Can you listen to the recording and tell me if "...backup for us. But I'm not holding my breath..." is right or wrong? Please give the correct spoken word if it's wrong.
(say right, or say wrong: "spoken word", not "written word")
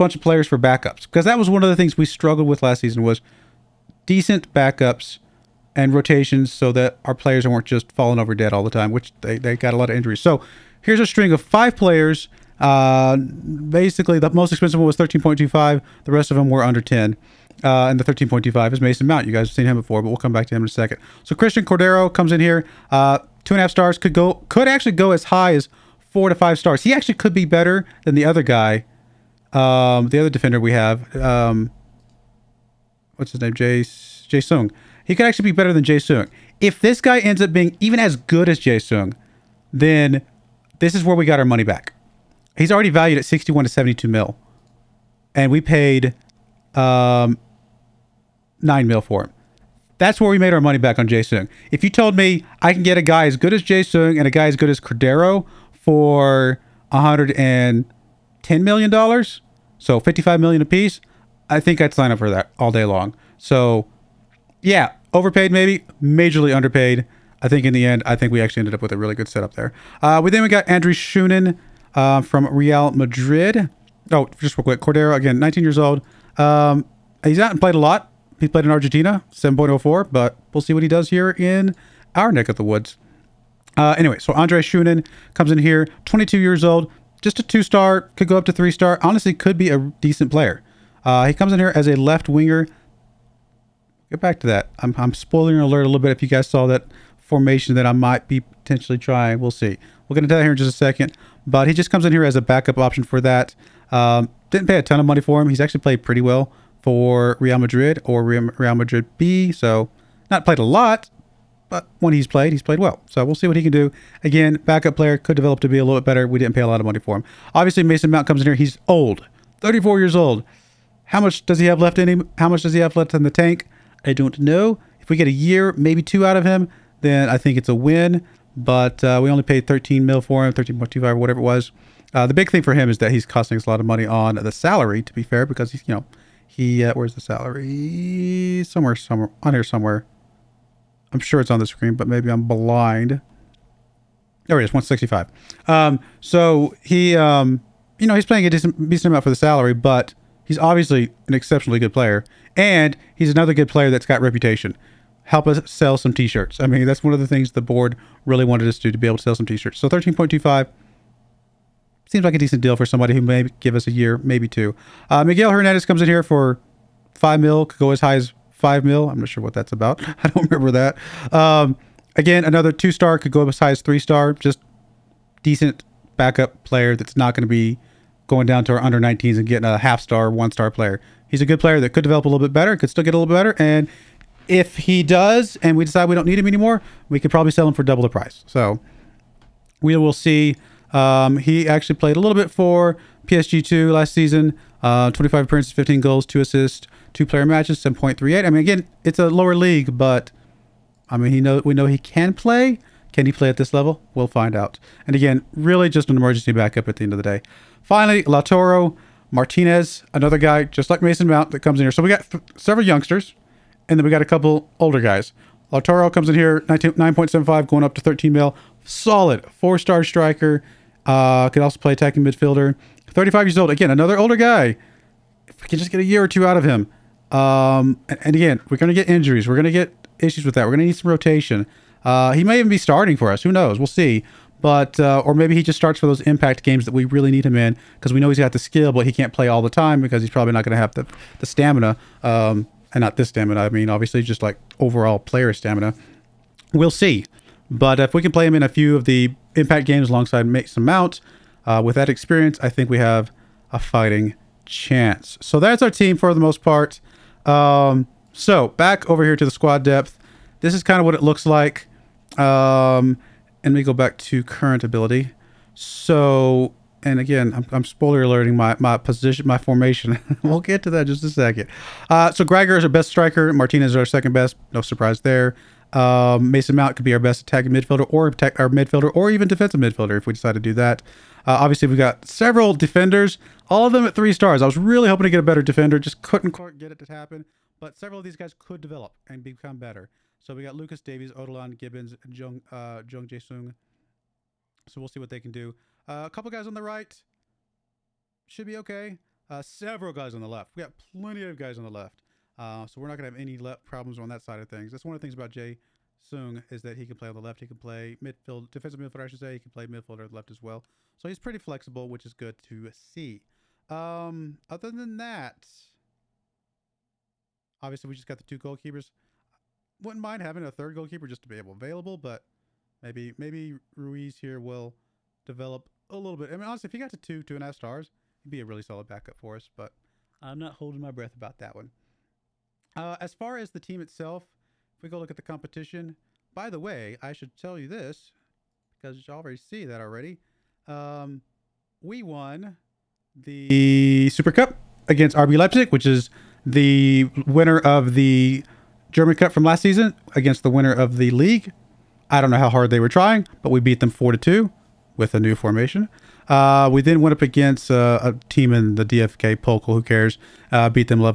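right.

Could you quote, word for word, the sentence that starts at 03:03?
And if he does and we decide we don't need him anymore, we could probably sell him for double the price.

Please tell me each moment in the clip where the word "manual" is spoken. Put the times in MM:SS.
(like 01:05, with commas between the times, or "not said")
not said.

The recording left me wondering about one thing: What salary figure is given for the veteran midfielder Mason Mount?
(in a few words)
165.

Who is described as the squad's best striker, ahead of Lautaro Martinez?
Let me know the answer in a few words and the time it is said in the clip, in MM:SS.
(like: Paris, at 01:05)
Gregor, at 04:32.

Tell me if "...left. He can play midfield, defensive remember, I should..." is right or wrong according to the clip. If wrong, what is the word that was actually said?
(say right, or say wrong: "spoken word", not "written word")
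wrong: "midfielder", not "remember".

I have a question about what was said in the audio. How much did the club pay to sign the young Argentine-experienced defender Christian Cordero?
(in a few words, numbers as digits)
9 mil.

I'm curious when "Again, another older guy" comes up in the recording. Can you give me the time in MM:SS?
03:43.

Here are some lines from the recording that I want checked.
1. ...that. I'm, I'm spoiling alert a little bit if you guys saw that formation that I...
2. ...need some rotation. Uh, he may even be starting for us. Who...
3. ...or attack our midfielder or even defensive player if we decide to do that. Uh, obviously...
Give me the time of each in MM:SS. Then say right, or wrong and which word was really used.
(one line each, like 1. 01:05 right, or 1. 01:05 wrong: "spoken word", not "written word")
1. 01:34 right
2. 03:50 right
3. 04:38 wrong: "midfielder", not "player".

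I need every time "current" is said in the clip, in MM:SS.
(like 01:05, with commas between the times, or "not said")
04:24.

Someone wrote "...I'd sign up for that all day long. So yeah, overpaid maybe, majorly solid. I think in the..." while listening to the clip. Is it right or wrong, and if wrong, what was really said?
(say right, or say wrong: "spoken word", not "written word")
wrong: "underpaid", not "solid".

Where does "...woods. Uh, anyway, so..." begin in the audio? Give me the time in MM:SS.
01:22.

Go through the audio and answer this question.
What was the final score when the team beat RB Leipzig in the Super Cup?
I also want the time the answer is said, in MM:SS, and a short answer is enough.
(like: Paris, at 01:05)
4 to 2, at 05:54.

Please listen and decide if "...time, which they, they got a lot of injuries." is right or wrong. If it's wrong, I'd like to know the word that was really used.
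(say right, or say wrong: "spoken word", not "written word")
right.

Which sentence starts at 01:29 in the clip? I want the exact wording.
Honestly, could be a decent player.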